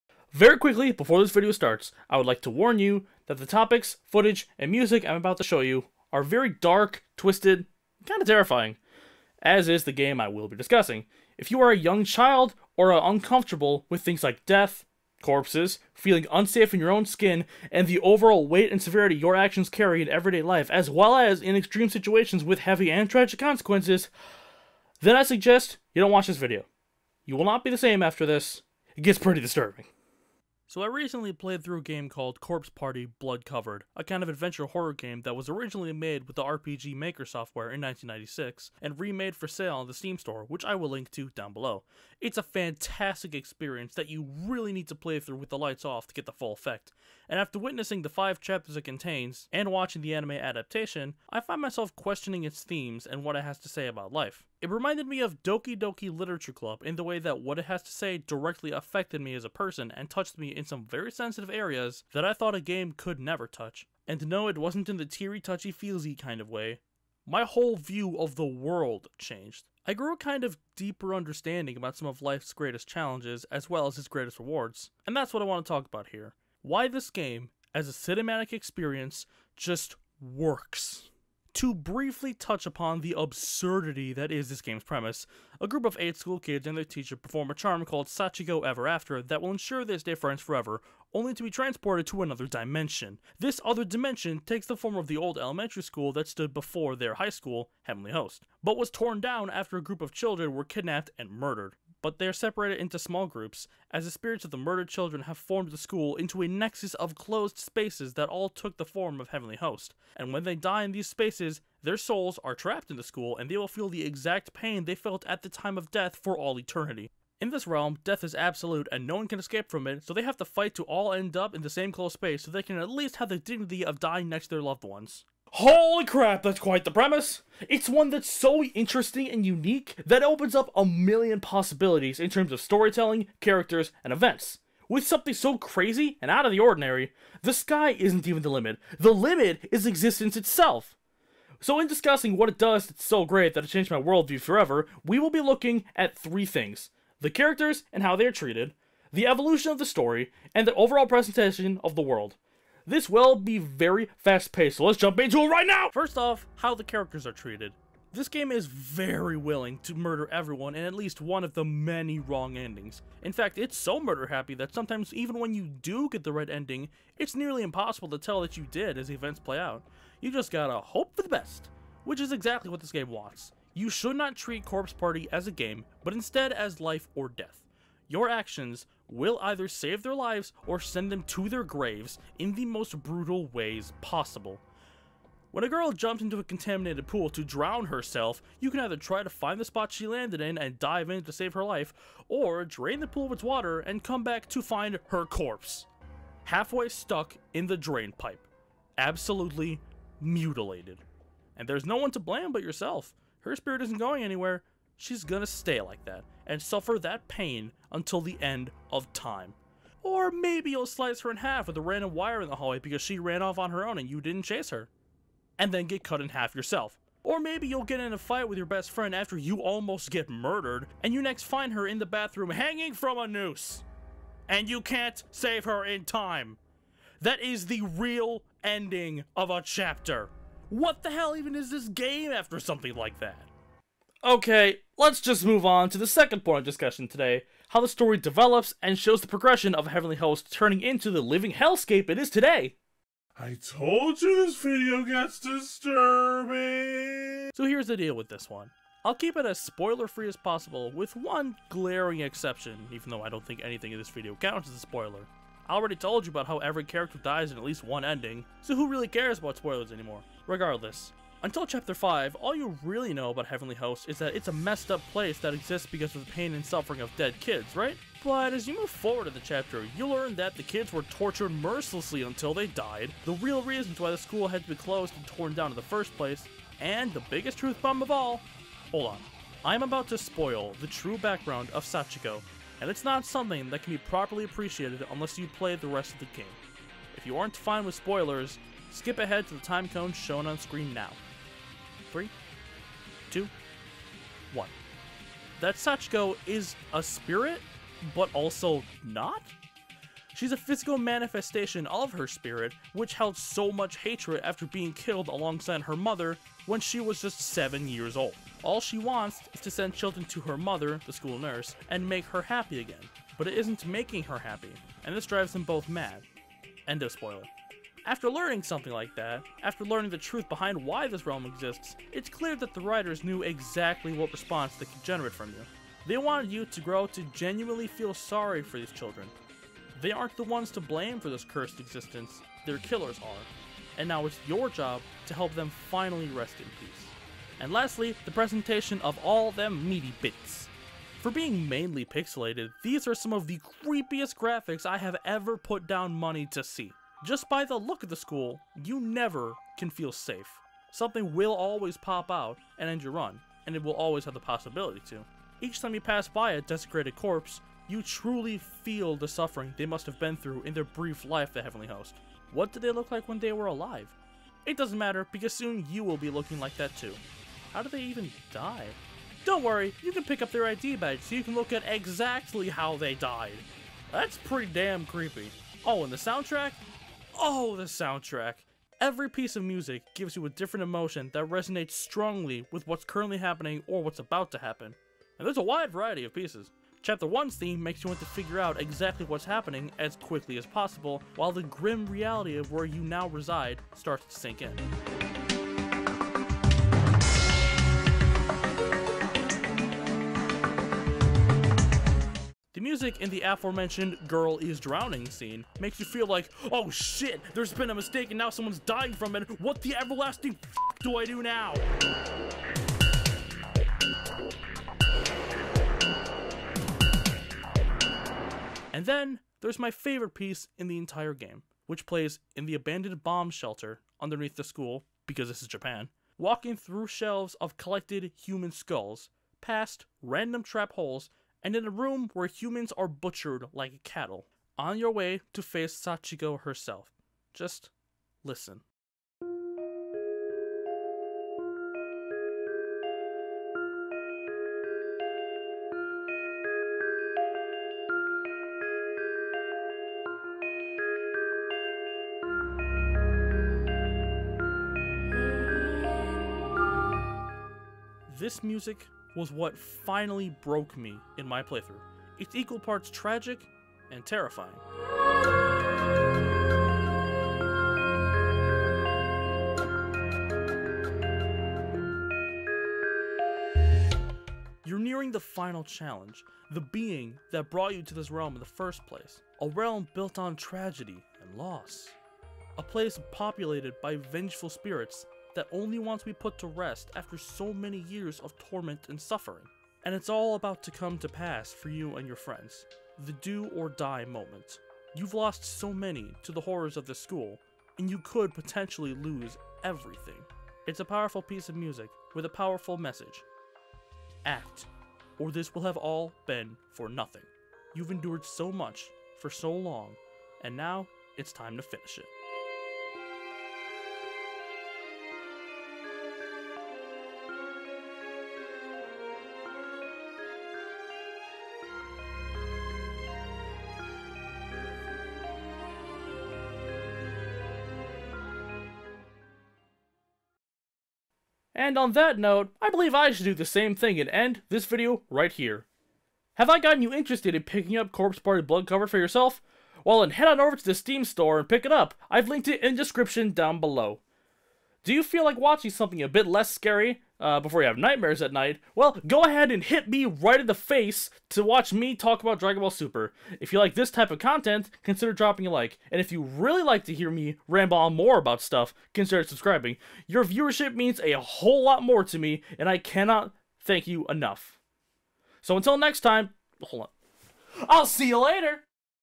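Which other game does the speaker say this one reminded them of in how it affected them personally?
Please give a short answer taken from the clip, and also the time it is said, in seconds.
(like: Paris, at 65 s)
Doki Doki Literature Club, at 55 s.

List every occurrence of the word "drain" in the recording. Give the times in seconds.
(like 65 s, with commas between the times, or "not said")
192 s, 197 s.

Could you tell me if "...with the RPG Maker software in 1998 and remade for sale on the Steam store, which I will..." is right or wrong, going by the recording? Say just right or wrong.
wrong.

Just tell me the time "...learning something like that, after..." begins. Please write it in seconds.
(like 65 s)
318 s.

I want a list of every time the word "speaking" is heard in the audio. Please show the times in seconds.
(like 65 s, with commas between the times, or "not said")
not said.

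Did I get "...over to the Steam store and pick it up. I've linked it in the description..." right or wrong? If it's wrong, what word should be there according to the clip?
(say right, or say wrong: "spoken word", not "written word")
right.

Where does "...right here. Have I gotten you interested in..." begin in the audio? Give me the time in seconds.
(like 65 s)
535 s.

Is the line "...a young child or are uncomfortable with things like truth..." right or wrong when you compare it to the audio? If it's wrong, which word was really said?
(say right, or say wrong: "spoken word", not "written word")
wrong: "death", not "truth".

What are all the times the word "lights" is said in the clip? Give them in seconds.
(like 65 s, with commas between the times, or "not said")
45 s.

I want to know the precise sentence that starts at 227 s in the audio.
That is the real ending of a chapter.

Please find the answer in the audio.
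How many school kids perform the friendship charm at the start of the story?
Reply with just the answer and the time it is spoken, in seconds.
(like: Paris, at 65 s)
8, at 85 s.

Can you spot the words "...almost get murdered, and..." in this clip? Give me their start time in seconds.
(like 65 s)
219 s.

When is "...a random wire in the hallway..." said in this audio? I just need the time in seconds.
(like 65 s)
211 s.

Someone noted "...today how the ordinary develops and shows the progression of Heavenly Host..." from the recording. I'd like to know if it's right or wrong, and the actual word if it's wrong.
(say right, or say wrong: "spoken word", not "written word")
wrong: "story", not "ordinary".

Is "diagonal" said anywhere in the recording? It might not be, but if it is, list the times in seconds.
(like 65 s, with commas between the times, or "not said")
not said.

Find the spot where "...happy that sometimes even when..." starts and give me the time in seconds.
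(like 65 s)
164 s.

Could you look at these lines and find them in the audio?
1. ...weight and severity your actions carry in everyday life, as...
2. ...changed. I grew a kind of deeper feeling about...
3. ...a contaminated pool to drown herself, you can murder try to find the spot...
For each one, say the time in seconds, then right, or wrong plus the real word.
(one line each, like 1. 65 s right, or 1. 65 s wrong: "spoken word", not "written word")
1. 18 s right
2. 69 s wrong: "understanding", not "feeling"
3. 186 s wrong: "either", not "murder".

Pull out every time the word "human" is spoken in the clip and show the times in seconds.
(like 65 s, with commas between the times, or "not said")
428 s, 432 s.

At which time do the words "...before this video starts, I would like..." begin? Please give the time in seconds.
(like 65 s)
0 s.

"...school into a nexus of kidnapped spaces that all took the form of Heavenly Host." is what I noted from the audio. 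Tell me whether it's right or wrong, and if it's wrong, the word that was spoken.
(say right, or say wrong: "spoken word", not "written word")
wrong: "closed", not "kidnapped".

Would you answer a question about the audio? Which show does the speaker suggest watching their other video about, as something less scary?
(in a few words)
Dragon Ball Super.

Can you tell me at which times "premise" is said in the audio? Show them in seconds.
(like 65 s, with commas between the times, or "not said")
84 s, 126 s.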